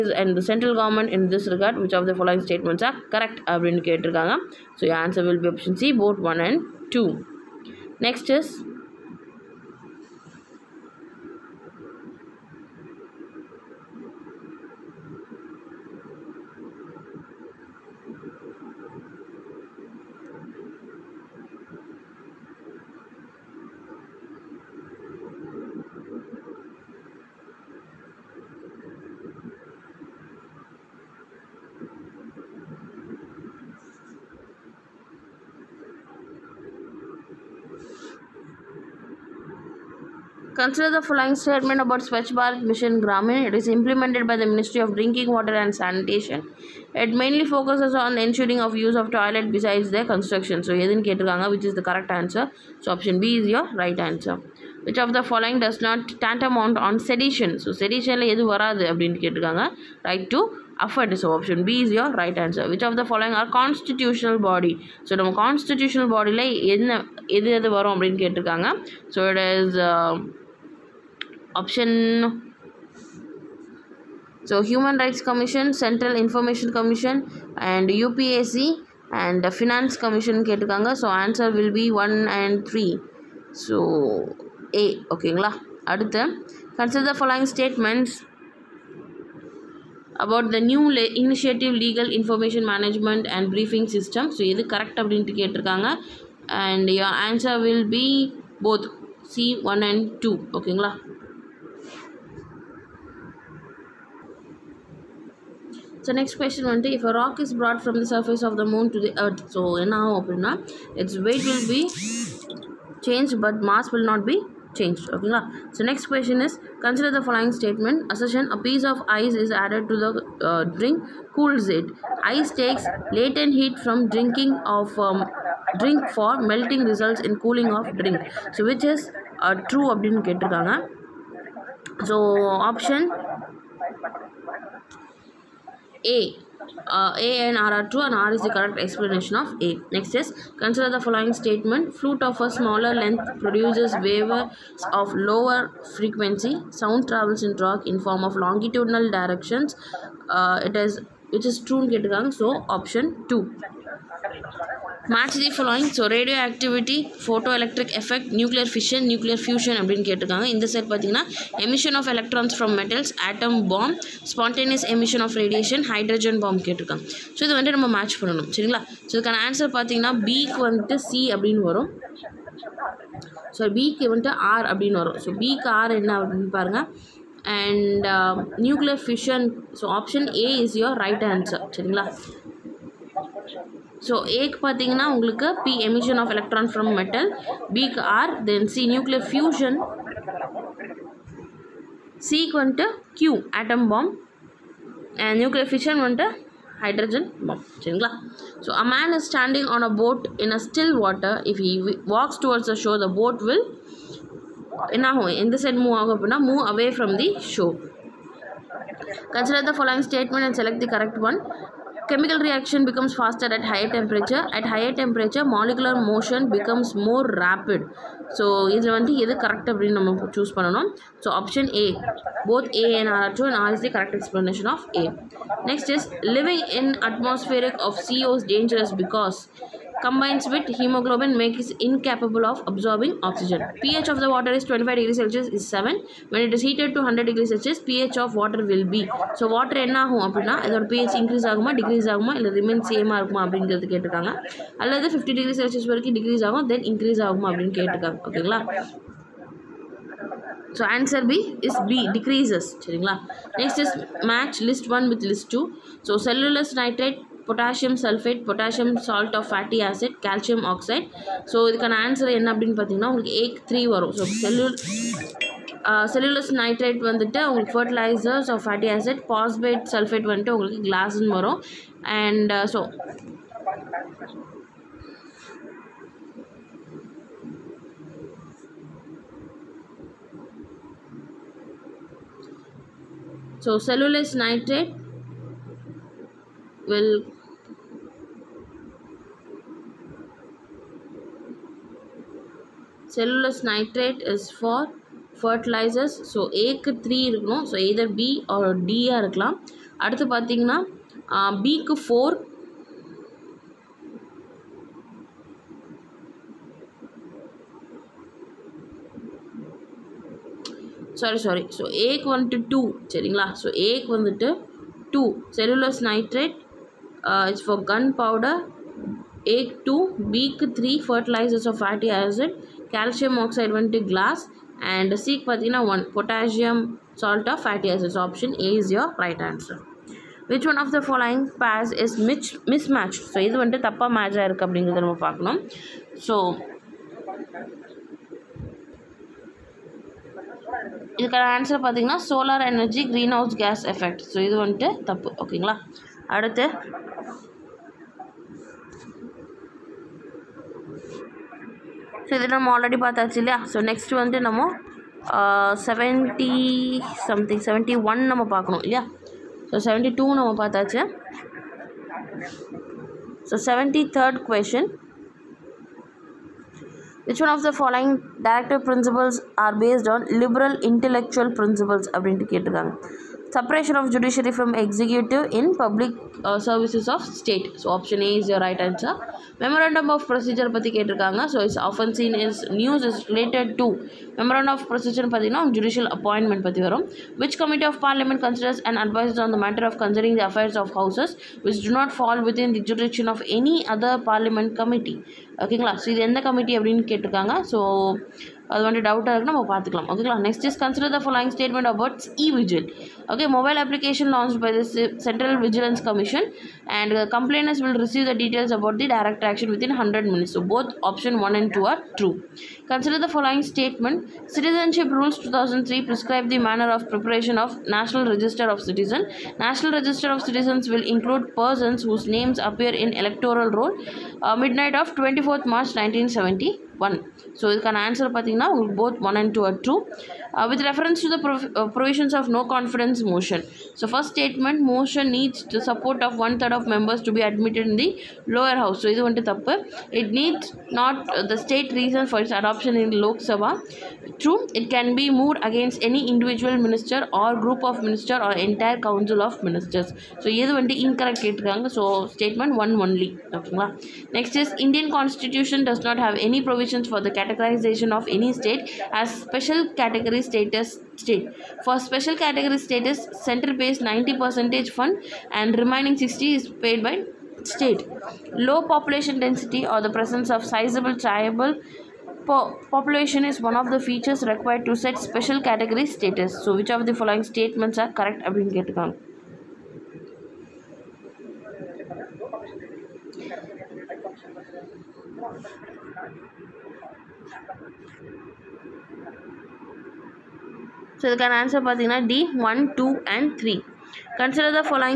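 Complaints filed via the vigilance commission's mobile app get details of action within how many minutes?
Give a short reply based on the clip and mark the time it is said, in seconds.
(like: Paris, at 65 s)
100 minutes, at 410 s.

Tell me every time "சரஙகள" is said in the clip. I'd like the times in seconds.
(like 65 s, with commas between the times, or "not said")
168 s, 181 s, 197 s, 252 s, 313 s.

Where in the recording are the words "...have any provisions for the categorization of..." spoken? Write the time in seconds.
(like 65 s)
456 s.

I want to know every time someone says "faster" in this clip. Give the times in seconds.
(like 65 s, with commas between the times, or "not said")
213 s.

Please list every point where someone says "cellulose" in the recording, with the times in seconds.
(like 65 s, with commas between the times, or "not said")
256 s, 283 s.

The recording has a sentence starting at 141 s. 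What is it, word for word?
Flute of a smaller length produces waves of lower frequency.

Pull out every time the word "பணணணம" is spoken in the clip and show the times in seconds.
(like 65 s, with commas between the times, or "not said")
168 s.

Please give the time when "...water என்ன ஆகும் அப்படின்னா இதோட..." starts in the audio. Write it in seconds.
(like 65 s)
239 s.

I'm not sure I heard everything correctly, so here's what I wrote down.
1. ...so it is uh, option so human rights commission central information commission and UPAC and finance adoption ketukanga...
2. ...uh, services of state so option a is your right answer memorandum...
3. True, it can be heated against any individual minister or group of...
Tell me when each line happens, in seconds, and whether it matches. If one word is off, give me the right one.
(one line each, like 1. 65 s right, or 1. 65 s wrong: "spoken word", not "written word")
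1. 69 s wrong: "commission", not "adoption"
2. 376 s right
3. 444 s wrong: "moved", not "heated".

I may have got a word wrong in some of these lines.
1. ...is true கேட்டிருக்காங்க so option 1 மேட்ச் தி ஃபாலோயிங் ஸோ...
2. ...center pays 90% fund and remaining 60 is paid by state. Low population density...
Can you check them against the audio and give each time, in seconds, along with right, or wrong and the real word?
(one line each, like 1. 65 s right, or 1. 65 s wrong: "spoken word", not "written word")
1. 151 s wrong: "2", not "1"
2. 463 s right.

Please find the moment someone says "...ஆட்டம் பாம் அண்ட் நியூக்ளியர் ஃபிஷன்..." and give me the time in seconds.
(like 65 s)
193 s.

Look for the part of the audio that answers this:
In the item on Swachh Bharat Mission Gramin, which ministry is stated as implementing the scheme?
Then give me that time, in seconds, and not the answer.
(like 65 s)
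44 s.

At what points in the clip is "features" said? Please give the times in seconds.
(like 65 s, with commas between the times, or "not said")
474 s.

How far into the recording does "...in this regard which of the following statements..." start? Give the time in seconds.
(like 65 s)
1 s.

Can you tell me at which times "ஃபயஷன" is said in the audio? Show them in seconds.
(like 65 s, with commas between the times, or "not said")
159 s, 189 s.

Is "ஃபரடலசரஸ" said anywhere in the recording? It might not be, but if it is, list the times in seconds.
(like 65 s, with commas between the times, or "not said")
267 s, 295 s, 321 s.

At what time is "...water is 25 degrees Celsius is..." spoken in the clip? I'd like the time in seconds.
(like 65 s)
234 s.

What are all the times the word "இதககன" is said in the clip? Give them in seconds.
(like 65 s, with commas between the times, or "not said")
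169 s, 261 s, 341 s.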